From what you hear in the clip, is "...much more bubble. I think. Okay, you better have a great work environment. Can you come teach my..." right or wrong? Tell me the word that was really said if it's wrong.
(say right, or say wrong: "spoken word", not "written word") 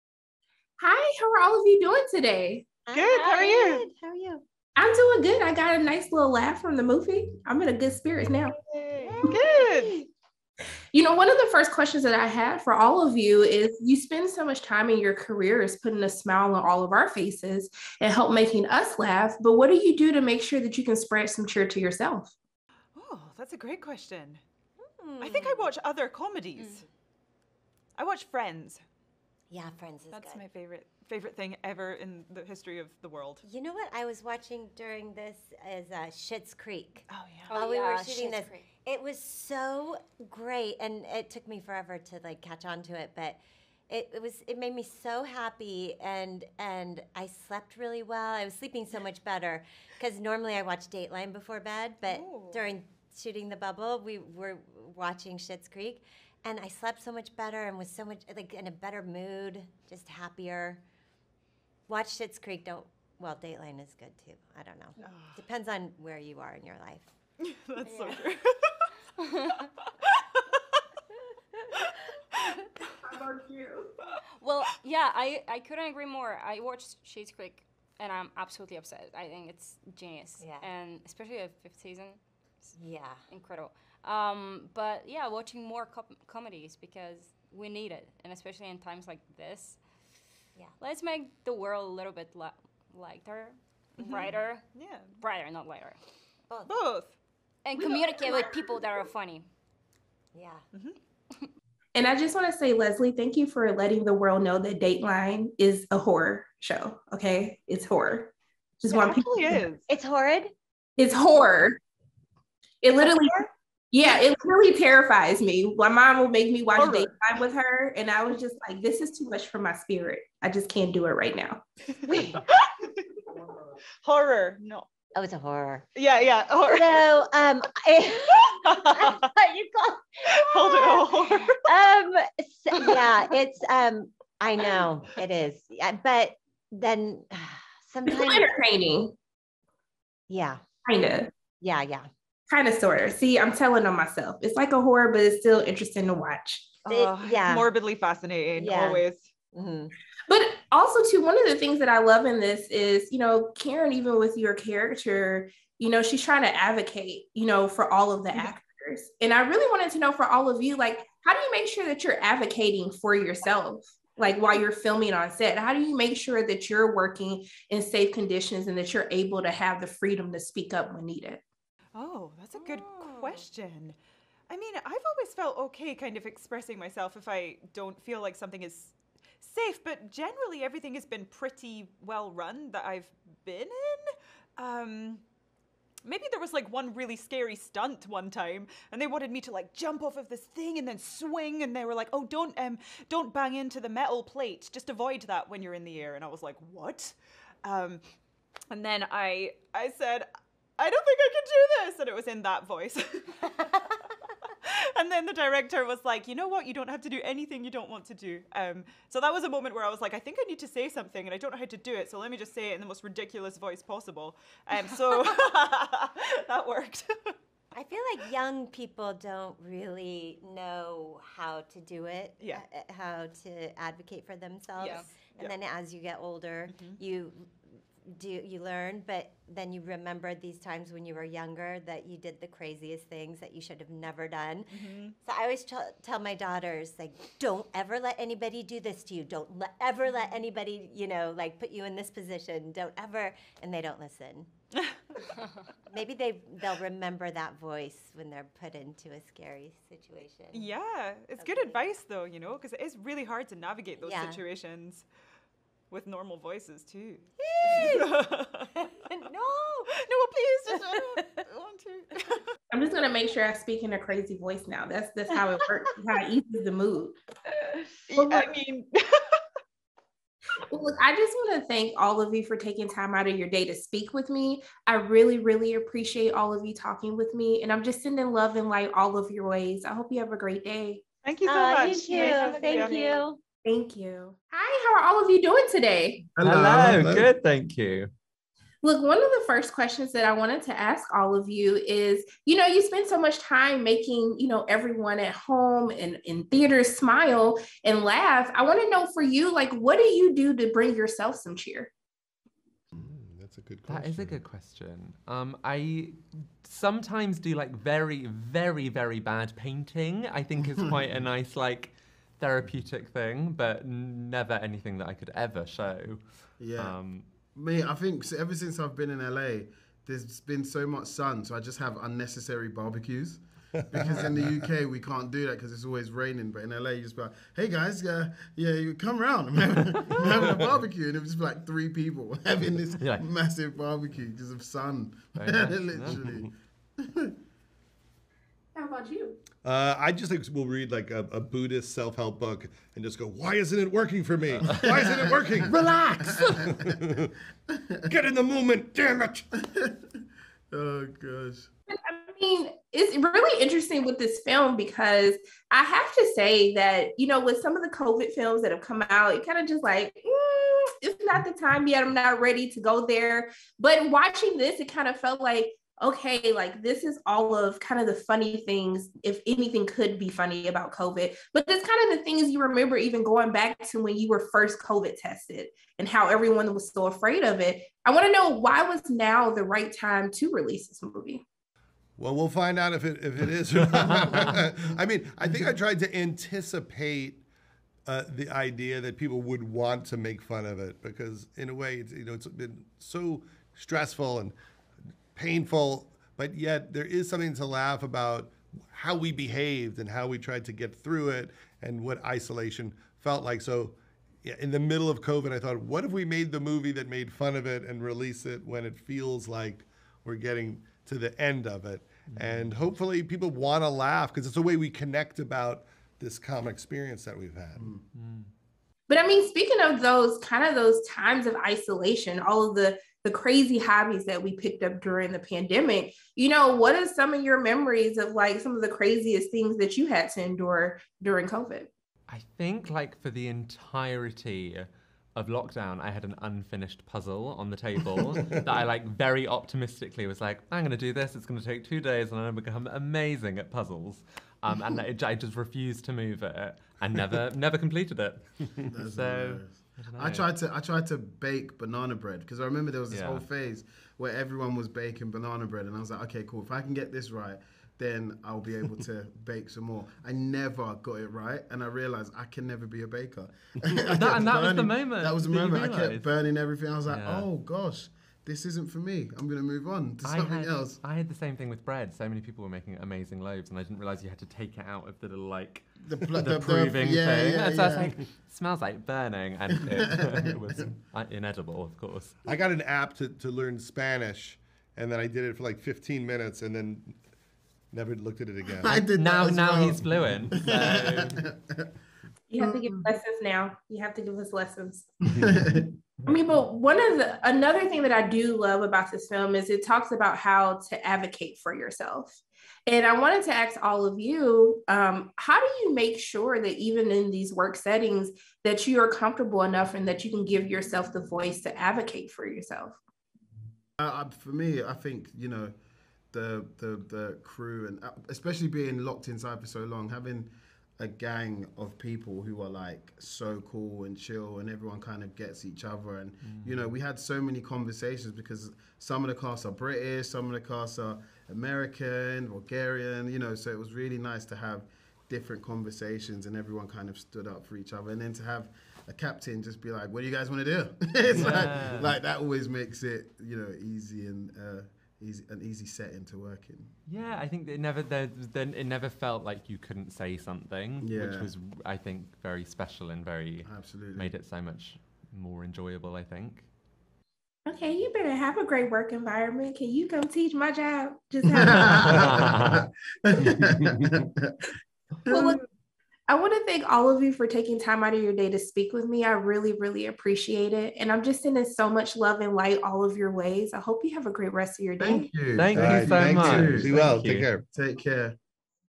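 wrong: "enjoyable", not "bubble".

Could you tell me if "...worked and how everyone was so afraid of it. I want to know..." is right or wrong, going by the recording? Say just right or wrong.
wrong.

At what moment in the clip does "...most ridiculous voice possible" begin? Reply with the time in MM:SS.
03:32.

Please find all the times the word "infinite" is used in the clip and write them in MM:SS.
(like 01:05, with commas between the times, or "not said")
not said.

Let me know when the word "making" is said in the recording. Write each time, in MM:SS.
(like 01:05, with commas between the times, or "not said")
00:18, 04:53, 07:52.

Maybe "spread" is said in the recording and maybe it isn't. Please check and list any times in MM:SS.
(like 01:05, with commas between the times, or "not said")
00:20.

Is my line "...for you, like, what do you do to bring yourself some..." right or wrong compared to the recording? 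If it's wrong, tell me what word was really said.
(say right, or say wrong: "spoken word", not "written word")
right.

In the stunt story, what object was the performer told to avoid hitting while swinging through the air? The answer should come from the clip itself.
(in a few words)
Metal plate.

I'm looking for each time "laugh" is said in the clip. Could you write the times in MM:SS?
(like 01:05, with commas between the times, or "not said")
00:06, 00:18, 04:58, 06:37, 06:53.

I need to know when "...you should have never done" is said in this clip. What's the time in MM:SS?
03:53.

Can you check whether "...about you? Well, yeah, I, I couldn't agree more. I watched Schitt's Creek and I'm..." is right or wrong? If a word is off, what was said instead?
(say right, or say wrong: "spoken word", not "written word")
right.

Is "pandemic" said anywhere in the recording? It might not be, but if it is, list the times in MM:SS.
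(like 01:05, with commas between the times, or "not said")
07:05.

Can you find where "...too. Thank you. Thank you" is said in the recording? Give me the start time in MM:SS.
04:42.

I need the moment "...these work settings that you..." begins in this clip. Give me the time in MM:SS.
08:27.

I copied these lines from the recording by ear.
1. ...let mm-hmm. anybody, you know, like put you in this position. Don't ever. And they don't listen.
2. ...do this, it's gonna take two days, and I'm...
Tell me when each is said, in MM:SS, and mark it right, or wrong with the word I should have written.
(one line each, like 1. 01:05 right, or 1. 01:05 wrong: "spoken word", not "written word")
1. 04:00 right
2. 07:20 right.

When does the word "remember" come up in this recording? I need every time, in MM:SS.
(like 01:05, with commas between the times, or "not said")
03:49, 04:06, 06:12, 07:32.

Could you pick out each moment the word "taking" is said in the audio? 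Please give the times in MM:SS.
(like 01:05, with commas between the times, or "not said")
04:32, 09:27.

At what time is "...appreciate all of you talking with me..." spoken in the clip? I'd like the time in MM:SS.
04:35.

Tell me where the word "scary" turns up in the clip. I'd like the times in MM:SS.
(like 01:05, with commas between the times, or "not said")
03:07, 04:09.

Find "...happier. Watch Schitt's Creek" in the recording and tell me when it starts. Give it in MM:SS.
01:00.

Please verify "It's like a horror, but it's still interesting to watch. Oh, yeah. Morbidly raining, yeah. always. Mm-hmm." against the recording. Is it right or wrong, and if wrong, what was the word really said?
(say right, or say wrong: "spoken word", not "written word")
wrong: "fascinating", not "raining".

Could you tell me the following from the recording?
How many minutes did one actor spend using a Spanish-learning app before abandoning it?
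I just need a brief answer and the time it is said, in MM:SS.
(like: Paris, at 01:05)
15, at 08:05.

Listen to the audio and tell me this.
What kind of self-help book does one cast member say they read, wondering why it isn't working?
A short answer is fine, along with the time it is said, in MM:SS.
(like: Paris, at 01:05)
Buddhist, at 05:41.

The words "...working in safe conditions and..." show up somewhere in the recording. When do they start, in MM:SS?
02:46.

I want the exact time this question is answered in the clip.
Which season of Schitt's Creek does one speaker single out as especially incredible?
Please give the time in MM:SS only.
01:21.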